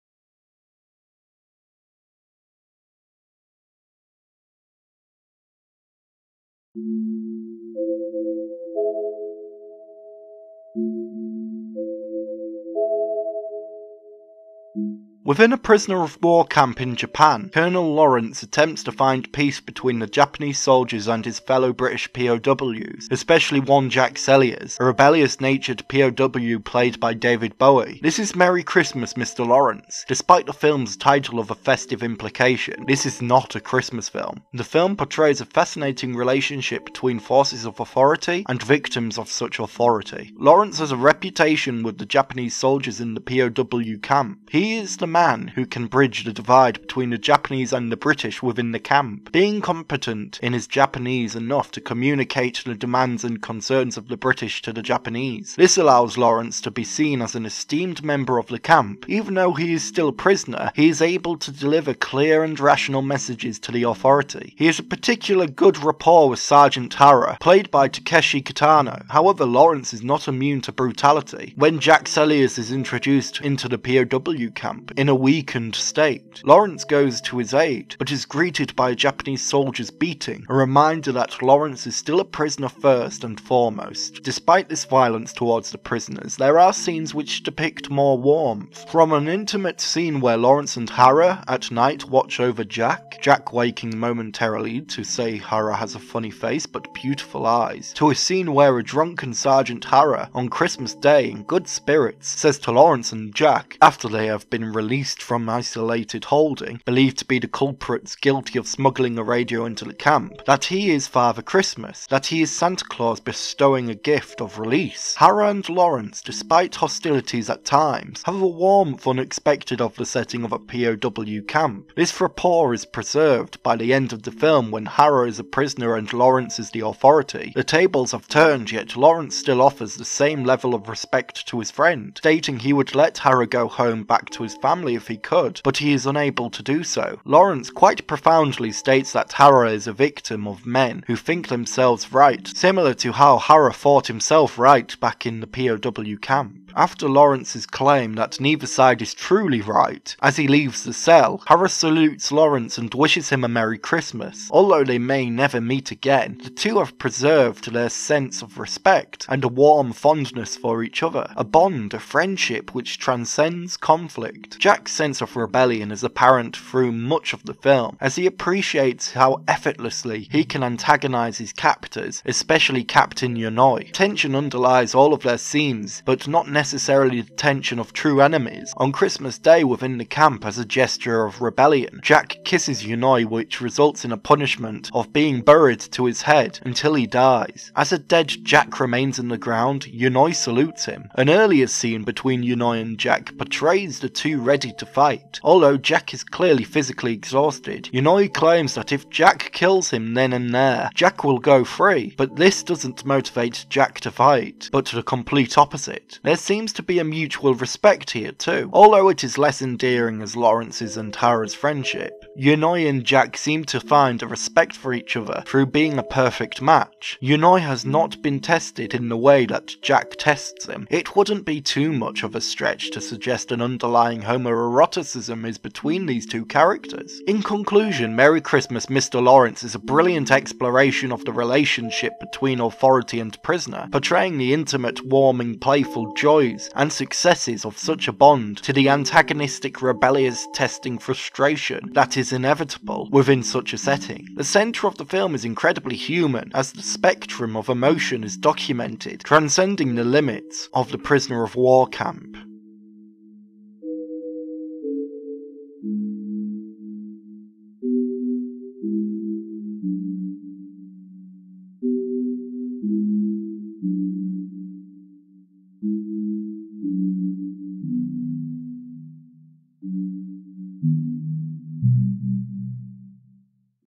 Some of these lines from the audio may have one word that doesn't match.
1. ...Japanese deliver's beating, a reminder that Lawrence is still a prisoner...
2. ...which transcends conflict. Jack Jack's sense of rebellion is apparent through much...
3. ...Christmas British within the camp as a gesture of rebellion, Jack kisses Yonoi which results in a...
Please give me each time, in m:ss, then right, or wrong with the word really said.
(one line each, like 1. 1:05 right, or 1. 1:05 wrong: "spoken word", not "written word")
1. 1:18 wrong: "soldier", not "deliver"
2. 2:42 right
3. 2:58 wrong: "Day", not "British".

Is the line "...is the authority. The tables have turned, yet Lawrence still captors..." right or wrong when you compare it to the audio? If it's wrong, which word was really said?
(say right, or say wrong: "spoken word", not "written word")
wrong: "offers", not "captors".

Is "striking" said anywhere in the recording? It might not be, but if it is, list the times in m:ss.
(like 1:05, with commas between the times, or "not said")
not said.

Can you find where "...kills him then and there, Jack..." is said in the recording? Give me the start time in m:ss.
3:19.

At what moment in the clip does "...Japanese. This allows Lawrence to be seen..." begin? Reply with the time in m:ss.
0:54.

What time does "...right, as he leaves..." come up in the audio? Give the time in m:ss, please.
2:29.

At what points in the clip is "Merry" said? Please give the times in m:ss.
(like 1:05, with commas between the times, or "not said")
0:28, 2:33, 3:48.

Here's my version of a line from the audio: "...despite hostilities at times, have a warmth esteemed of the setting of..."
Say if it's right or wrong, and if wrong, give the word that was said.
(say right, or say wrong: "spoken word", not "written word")
wrong: "unexpected", not "esteemed".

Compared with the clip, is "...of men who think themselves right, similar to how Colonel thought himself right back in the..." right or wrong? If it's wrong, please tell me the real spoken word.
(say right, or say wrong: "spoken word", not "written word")
wrong: "Hara", not "Colonel".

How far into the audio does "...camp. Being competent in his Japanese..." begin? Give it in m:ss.
0:48.